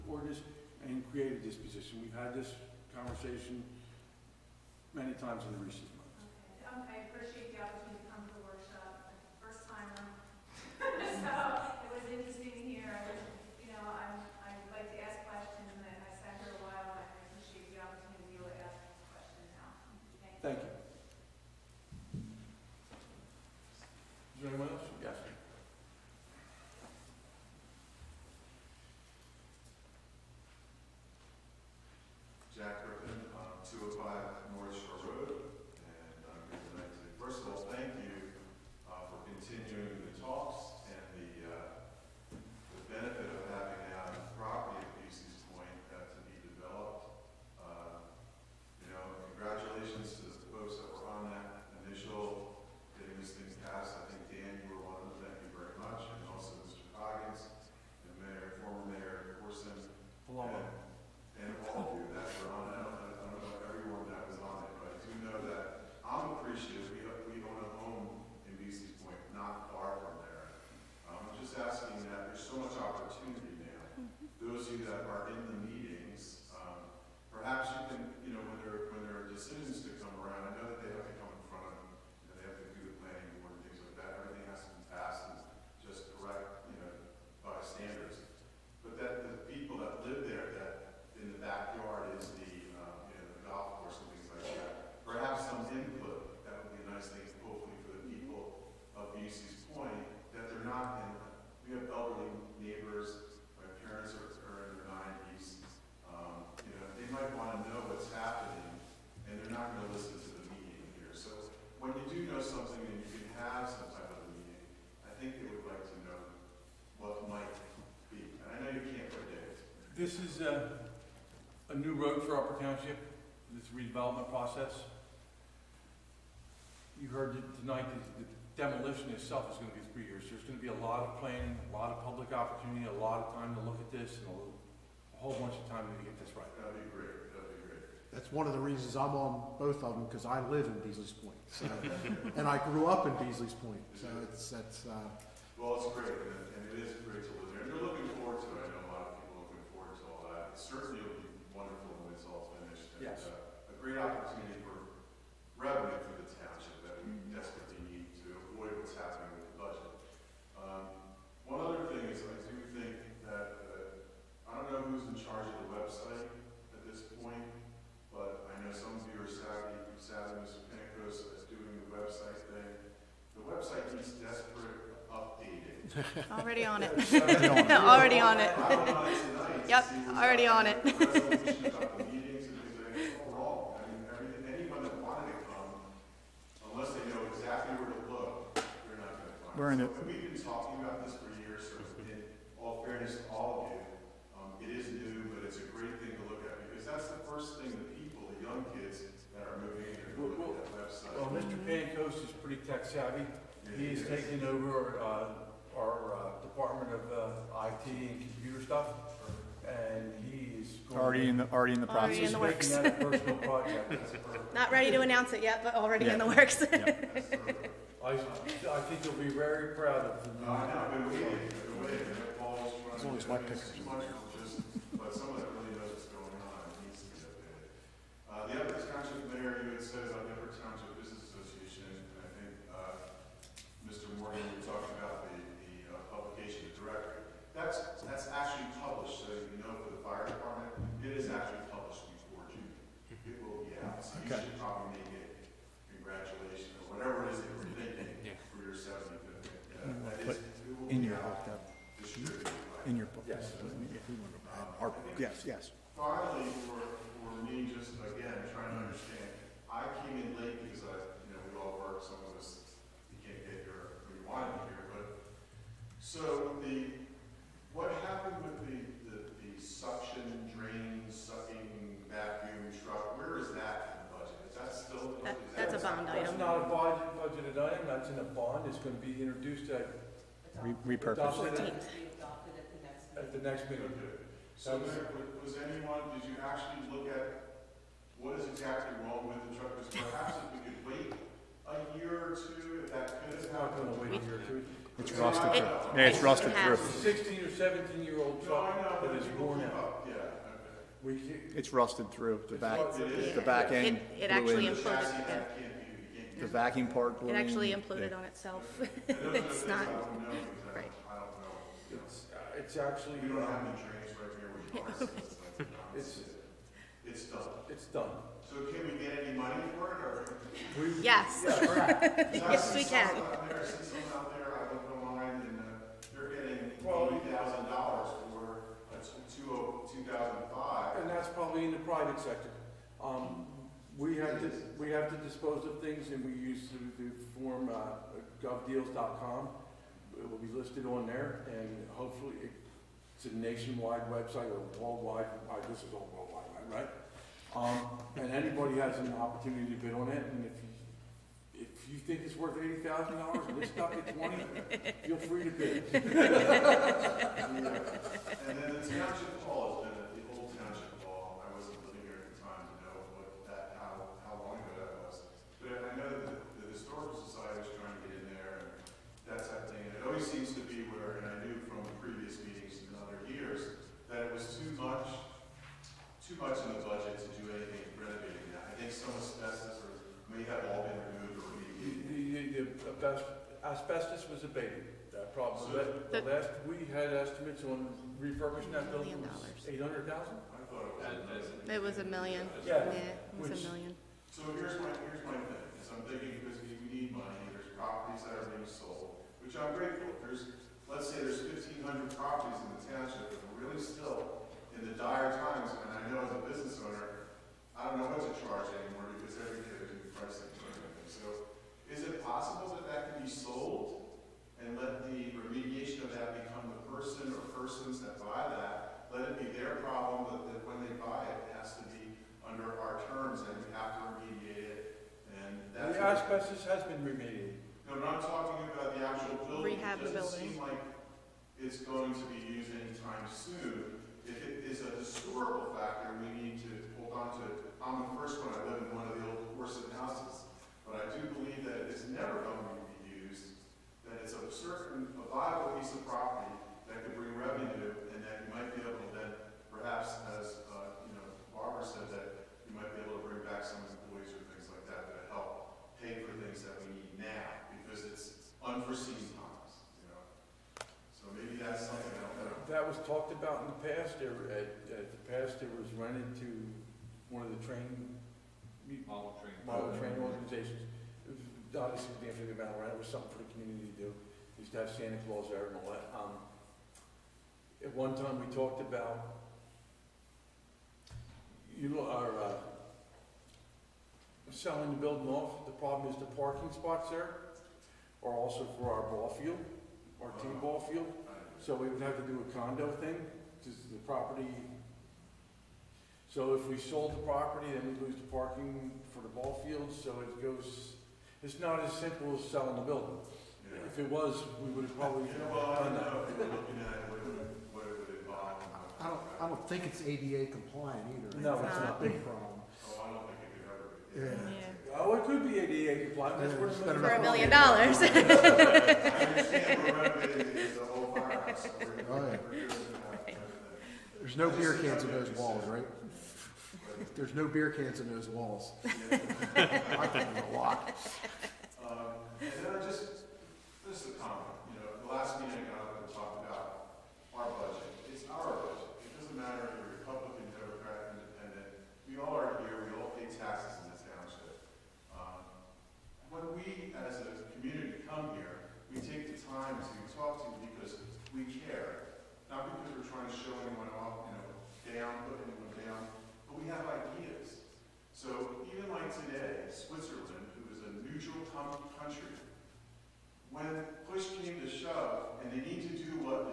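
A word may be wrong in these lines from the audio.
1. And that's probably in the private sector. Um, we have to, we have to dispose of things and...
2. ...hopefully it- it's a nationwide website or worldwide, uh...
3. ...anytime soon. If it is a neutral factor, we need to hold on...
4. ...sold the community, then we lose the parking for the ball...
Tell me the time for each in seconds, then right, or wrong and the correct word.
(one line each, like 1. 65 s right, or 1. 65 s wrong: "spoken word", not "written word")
1. 331 s right
2. 341 s right
3. 432 s wrong: "historical", not "neutral"
4. 496 s wrong: "property", not "community".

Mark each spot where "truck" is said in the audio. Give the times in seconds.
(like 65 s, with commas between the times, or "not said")
289 s, 298 s.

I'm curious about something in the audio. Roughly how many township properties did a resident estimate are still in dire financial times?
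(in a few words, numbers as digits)
1,500.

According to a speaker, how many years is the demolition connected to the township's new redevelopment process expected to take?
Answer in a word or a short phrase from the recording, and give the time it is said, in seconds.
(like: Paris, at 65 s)
3 years, at 129 s.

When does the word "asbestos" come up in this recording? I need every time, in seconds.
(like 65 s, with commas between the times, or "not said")
383 s, 426 s.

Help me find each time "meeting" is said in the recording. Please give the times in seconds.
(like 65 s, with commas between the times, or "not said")
283 s, 535 s.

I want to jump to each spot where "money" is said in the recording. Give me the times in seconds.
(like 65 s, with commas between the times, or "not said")
319 s, 397 s.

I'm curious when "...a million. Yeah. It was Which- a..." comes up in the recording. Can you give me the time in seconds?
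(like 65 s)
391 s.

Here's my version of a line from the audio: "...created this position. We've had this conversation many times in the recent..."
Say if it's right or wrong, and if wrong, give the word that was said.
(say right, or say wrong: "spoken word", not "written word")
right.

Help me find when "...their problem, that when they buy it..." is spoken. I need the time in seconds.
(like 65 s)
419 s.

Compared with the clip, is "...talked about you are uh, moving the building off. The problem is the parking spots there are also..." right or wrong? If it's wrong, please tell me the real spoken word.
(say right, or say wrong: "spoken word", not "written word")
wrong: "selling", not "moving".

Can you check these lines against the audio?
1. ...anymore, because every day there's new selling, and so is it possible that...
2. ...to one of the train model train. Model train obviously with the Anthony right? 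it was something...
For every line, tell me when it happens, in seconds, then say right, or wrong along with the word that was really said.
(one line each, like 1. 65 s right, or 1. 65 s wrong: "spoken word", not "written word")
1. 408 s wrong: "pricing", not "selling"
2. 466 s right.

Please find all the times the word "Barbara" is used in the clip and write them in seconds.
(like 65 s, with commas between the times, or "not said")
451 s.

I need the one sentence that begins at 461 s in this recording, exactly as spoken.
So maybe that's something I don't know.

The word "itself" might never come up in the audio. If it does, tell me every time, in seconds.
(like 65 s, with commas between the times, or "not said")
129 s, 308 s.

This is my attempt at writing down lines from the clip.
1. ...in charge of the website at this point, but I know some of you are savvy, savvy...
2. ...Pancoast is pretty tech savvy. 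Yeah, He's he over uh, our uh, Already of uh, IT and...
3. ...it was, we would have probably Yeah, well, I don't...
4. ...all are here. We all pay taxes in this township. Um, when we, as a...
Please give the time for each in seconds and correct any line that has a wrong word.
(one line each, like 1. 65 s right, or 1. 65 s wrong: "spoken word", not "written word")
1. 165 s right
2. 201 s wrong: "Department", not "Already"
3. 503 s right
4. 542 s right.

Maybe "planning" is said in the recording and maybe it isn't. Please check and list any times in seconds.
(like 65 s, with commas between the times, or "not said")
131 s.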